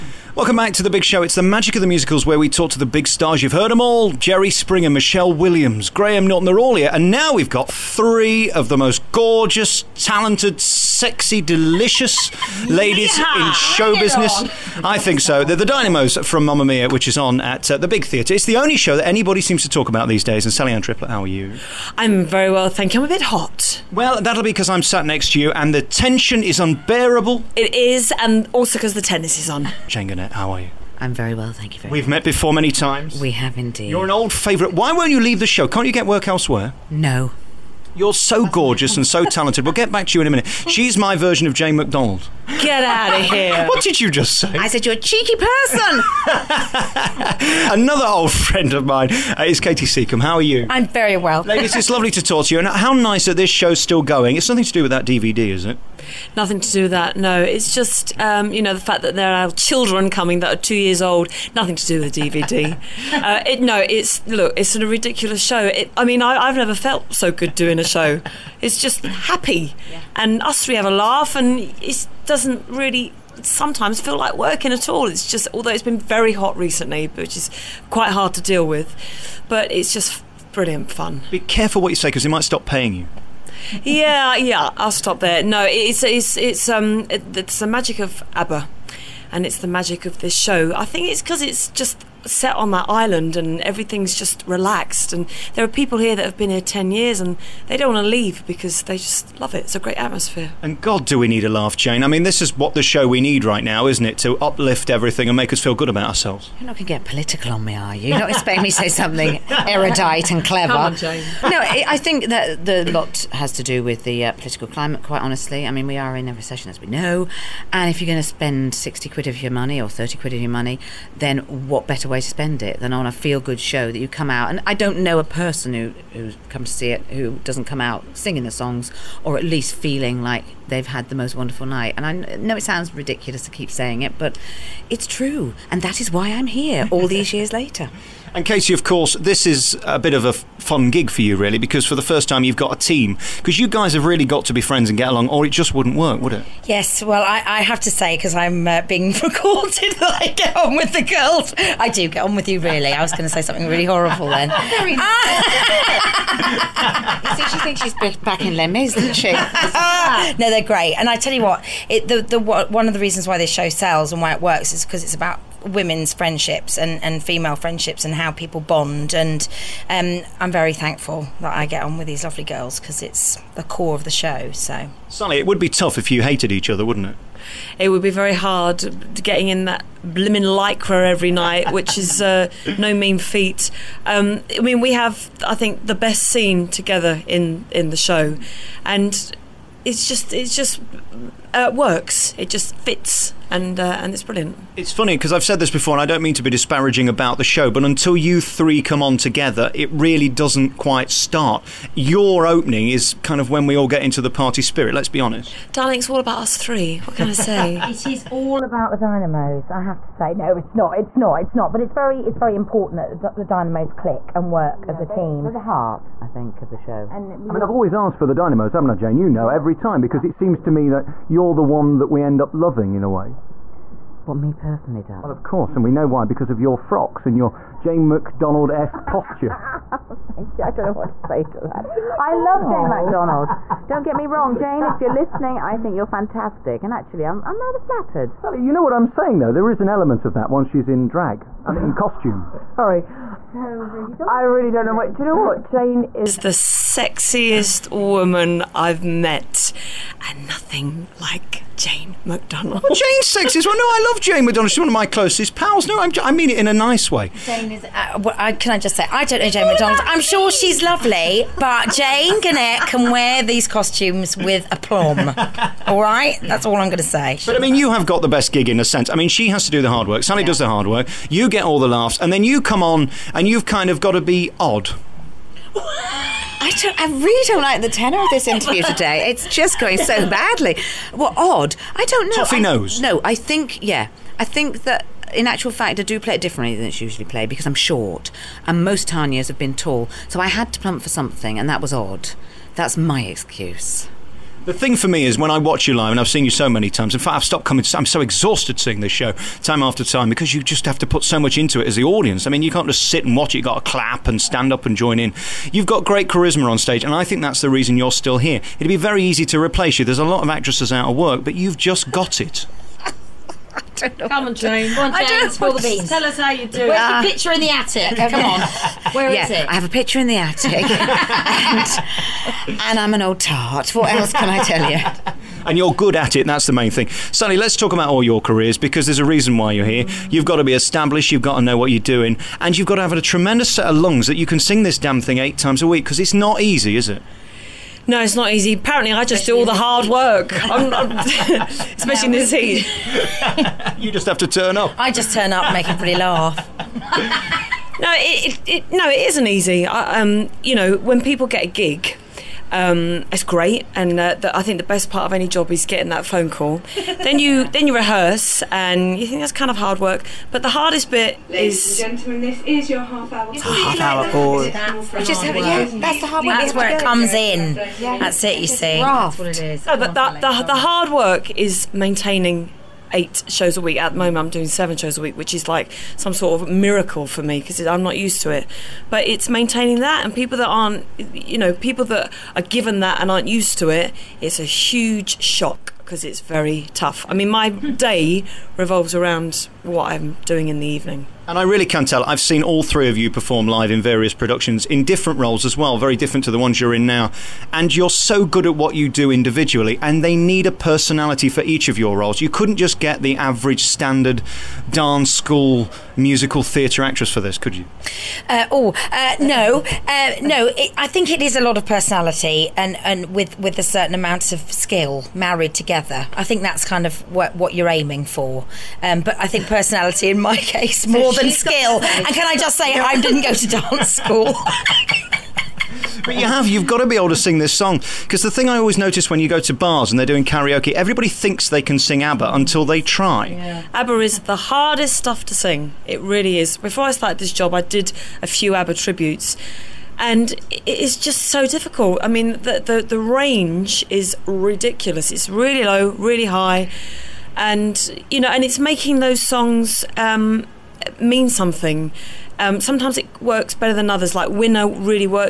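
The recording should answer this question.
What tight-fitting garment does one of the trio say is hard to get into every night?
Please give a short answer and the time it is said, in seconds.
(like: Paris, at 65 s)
Lycra, at 180 s.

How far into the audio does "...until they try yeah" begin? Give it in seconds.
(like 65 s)
432 s.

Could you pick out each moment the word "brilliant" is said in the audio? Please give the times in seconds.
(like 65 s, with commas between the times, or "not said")
80 s, 194 s.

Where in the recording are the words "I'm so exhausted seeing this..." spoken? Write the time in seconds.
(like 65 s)
297 s.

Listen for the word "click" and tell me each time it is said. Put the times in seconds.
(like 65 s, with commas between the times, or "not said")
213 s.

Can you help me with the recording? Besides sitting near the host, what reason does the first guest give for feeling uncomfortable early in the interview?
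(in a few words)
The tennis is on.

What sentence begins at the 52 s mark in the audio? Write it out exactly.
And how nice that this show's still going.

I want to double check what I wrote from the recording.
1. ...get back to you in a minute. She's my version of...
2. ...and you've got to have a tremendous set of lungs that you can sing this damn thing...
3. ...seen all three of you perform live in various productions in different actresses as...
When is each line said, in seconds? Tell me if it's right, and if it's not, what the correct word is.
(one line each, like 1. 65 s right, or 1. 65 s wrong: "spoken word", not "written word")
1. 39 s right
2. 332 s right
3. 392 s wrong: "roles", not "actresses".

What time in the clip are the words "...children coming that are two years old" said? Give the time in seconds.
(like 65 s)
59 s.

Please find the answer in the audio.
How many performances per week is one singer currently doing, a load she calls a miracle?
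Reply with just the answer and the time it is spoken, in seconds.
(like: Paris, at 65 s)
7, at 374 s.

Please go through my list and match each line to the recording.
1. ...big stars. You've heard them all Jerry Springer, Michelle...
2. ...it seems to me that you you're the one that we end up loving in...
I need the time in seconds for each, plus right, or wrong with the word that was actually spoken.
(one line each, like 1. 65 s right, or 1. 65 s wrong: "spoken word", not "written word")
1. 2 s right
2. 220 s right.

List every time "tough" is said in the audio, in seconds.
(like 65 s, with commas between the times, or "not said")
175 s, 386 s.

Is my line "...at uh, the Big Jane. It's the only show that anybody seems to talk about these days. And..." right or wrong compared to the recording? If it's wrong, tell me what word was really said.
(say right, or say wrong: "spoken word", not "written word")
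wrong: "Theatre", not "Jane".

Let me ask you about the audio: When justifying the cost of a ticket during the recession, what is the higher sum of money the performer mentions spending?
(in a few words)
60 quid.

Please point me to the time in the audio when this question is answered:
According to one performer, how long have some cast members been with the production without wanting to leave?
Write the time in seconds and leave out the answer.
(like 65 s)
96 s.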